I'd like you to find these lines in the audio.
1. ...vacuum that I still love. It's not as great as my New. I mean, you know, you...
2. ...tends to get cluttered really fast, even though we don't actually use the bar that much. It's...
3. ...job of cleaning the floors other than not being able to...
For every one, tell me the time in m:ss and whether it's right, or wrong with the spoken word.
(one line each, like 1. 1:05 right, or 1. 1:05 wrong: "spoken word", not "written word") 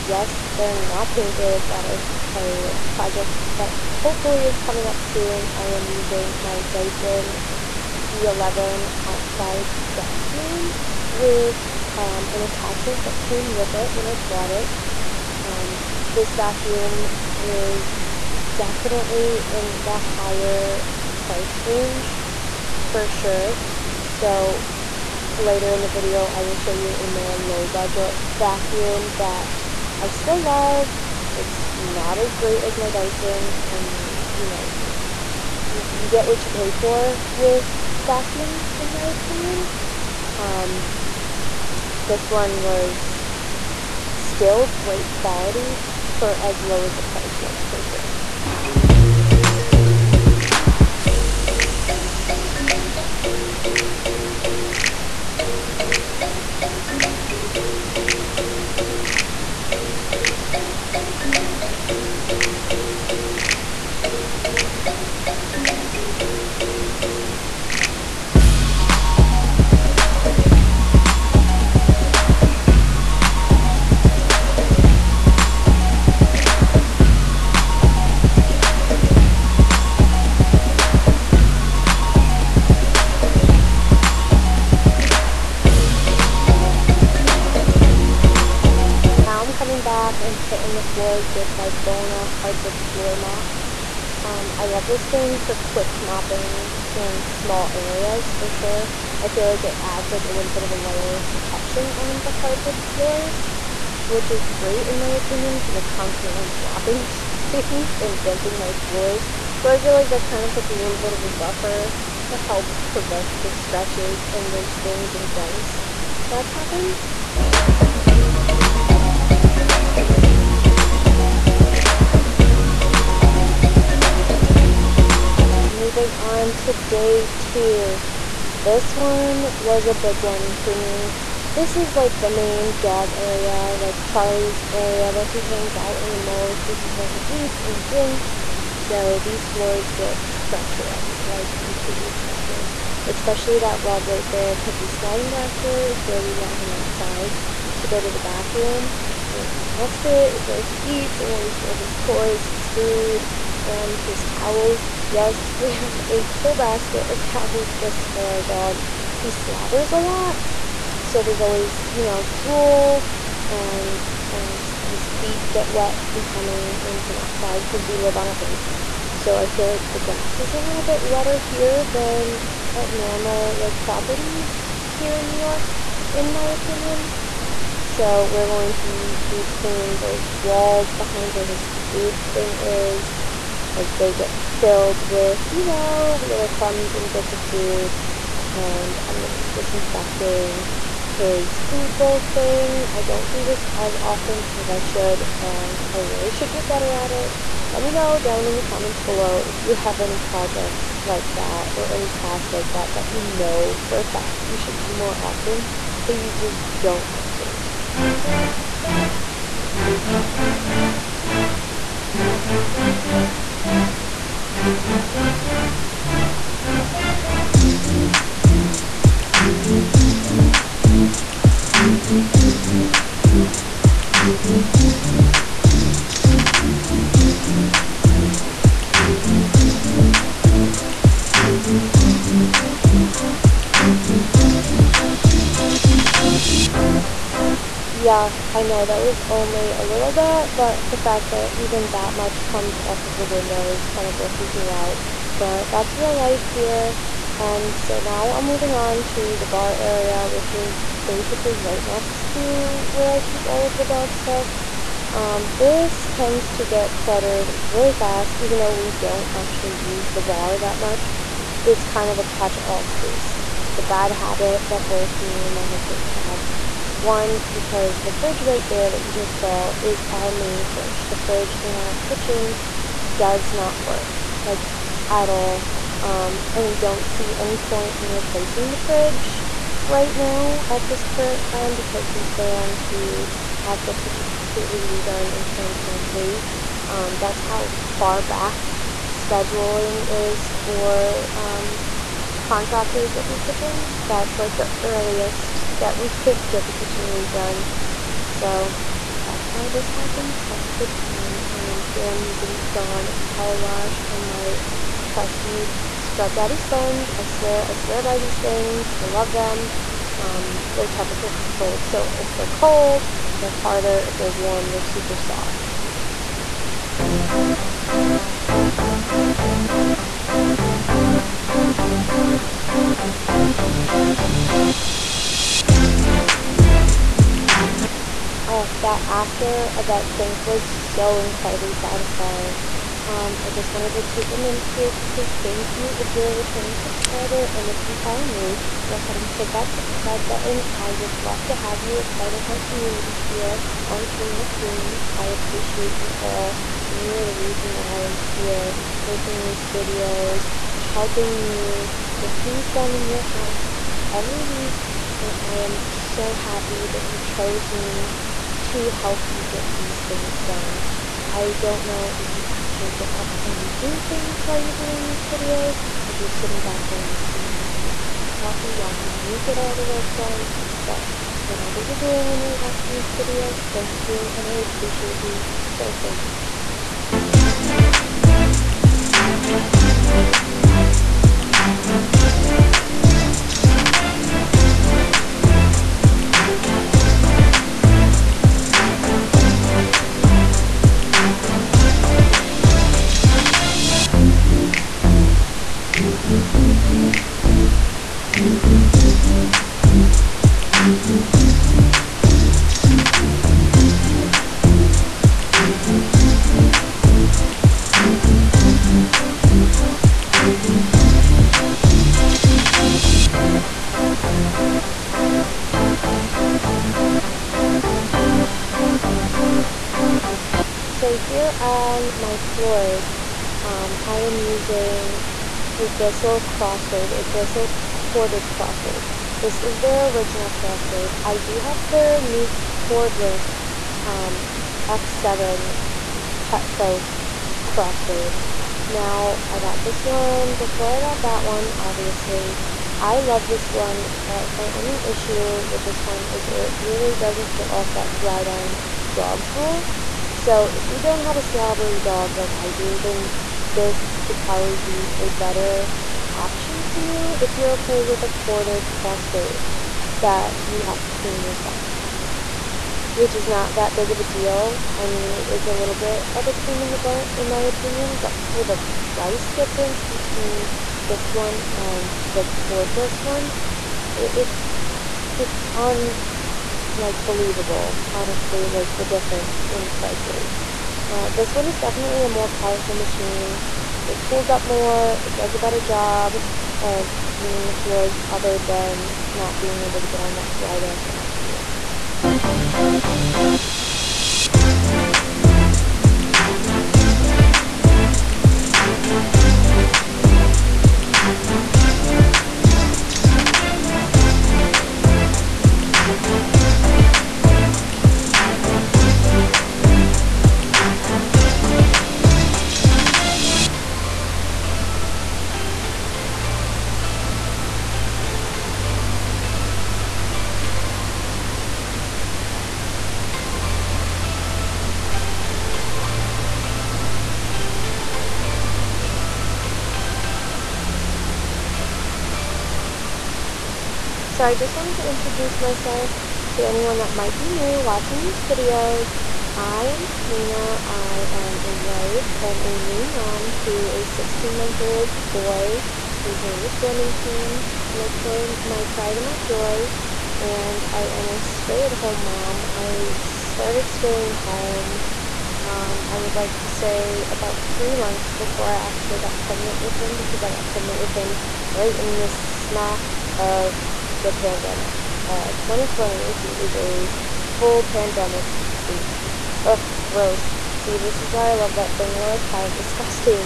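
1. 0:28 wrong: "Dyson", not "New"
2. 4:16 right
3. 8:05 right.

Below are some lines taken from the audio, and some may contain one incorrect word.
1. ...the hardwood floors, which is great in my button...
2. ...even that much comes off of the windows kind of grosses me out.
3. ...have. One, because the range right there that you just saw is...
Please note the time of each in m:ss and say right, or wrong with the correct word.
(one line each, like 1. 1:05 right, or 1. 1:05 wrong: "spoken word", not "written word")
1. 1:42 wrong: "opinion", not "button"
2. 4:01 right
3. 4:26 wrong: "fridge", not "range".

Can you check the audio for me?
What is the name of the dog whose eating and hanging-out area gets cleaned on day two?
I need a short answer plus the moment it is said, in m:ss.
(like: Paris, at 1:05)
Charlie, at 2:14.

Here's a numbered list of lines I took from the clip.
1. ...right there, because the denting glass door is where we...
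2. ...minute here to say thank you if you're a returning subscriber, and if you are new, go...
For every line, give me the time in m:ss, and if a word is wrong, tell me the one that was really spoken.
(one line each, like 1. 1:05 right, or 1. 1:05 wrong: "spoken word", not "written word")
1. 2:24 wrong: "sliding", not "denting"
2. 5:34 right.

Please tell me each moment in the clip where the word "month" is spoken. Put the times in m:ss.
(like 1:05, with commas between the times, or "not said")
9:04, 9:17.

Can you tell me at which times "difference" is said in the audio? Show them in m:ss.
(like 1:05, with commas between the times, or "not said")
7:49, 7:59.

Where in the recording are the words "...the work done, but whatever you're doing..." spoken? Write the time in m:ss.
6:09.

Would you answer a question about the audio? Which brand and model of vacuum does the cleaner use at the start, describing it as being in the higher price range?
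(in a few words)
Dyson V11.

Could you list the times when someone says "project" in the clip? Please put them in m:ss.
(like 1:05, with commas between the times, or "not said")
0:02, 3:20.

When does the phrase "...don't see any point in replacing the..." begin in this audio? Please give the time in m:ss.
4:36.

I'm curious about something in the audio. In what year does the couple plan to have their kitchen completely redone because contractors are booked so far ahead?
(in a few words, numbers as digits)
2023.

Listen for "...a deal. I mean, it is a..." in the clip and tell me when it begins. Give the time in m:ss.
7:44.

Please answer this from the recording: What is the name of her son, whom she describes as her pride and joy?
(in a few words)
Remington.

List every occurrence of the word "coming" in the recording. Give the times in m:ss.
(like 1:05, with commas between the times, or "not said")
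0:04, 2:46.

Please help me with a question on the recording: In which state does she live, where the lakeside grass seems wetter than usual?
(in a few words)
New York.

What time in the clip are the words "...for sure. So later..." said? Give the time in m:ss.
0:22.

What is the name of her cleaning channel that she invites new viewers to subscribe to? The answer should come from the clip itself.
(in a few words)
Koreena Cleans.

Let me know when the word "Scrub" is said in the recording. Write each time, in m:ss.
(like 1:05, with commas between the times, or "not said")
5:05.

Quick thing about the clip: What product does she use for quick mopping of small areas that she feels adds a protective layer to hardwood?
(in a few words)
Bona hardwood floor mop.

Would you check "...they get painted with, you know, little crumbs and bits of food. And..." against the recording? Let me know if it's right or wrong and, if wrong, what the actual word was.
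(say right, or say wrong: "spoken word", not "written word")
wrong: "filled", not "painted".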